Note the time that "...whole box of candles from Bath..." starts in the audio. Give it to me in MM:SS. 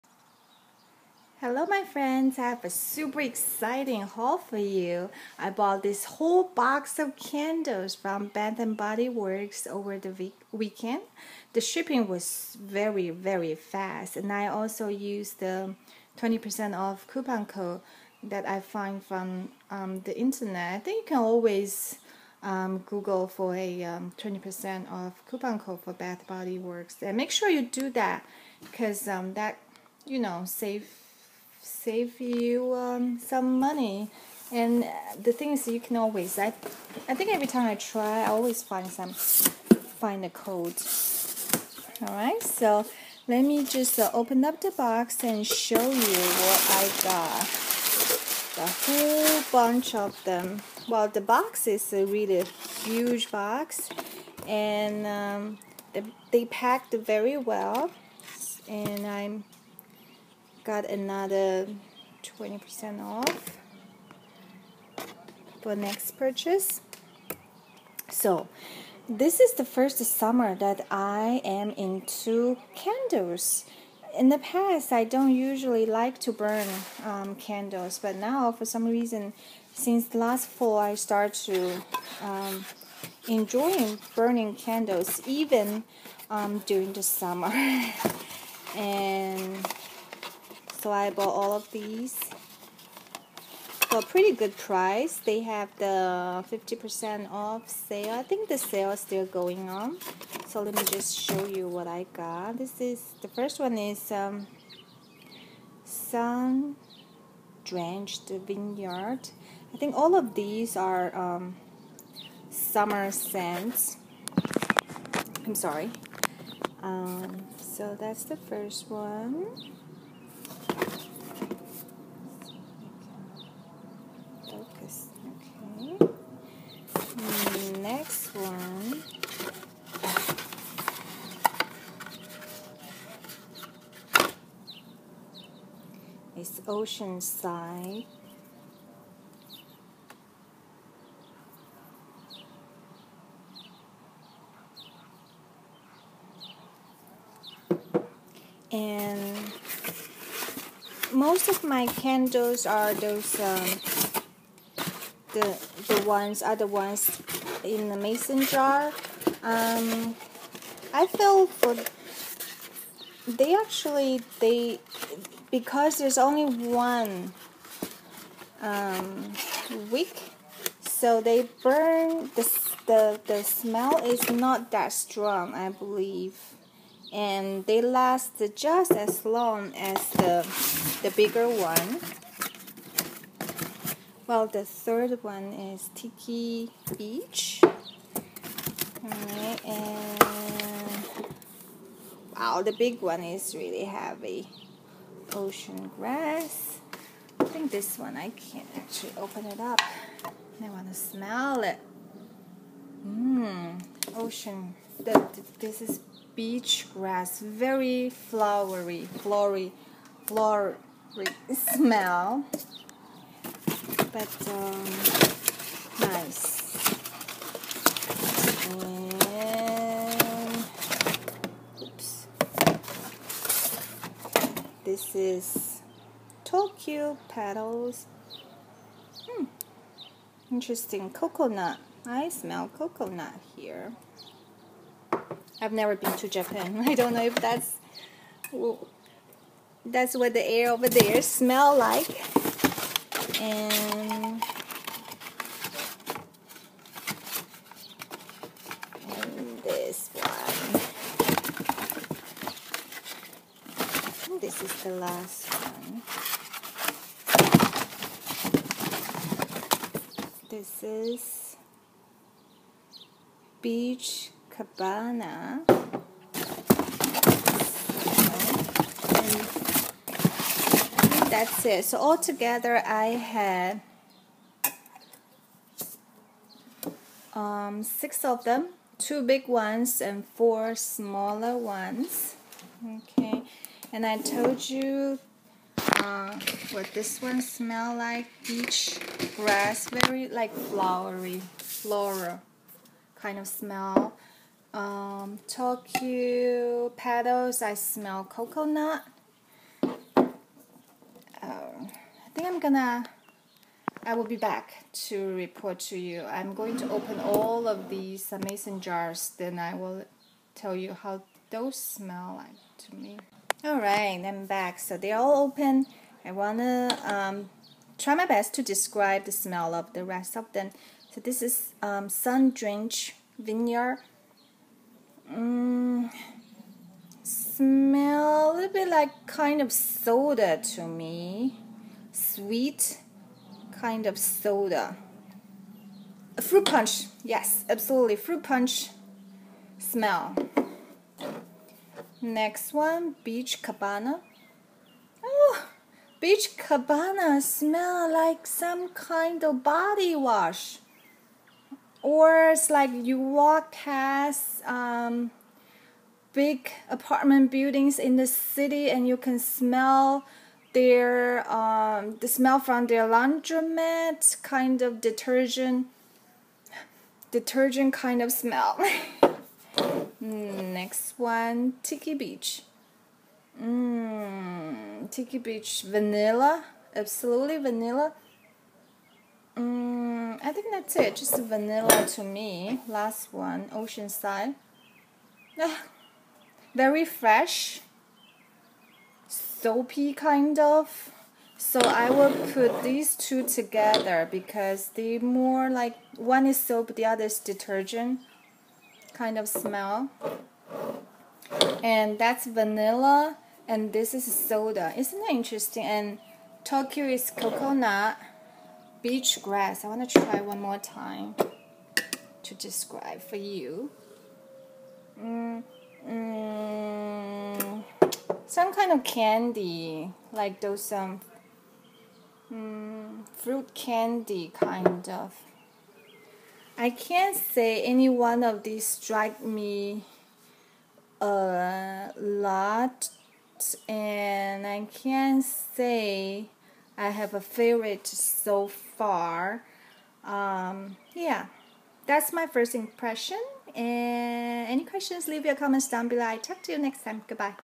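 00:06.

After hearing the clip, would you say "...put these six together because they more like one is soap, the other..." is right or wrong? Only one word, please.
wrong.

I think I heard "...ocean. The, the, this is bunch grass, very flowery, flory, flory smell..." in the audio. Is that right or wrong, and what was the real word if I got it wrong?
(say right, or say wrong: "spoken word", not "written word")
wrong: "beach", not "bunch".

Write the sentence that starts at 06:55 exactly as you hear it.
Mm um, some kind of candy, like those um, mm, fruit candy kind of.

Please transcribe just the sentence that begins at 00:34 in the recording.
And the thing is, you can always.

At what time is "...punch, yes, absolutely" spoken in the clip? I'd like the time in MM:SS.
05:36.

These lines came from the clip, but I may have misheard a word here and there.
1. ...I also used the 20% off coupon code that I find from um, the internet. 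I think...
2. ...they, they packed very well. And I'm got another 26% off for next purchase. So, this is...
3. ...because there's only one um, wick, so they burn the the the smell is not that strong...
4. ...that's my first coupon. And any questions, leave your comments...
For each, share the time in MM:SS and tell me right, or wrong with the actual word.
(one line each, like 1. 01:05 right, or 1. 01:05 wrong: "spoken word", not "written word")
1. 00:14 right
2. 00:55 wrong: "20", not "26"
3. 02:45 right
4. 07:22 wrong: "impression", not "coupon".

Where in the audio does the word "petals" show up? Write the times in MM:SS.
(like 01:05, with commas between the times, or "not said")
03:47, 04:56.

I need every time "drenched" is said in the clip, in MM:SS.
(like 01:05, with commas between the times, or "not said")
01:47, 05:22.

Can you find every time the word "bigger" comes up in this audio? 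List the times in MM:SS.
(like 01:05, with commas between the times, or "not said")
03:01.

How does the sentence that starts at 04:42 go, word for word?
Okay, and I told you uh, what this one smell like, peach, grass, very like flowery, floral kind of smell.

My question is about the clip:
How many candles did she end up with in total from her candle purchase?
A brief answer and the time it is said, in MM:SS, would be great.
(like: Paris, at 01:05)
6, at 04:37.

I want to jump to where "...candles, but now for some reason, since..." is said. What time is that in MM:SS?
01:17.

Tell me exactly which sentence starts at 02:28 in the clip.
And most of my candles are those um, the the ones are the ones in the mason jar.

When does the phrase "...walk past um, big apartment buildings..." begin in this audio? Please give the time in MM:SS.
05:53.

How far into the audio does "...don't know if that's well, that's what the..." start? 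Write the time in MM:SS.
03:56.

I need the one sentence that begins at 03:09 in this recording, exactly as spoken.
and wow, the big one is really heavy.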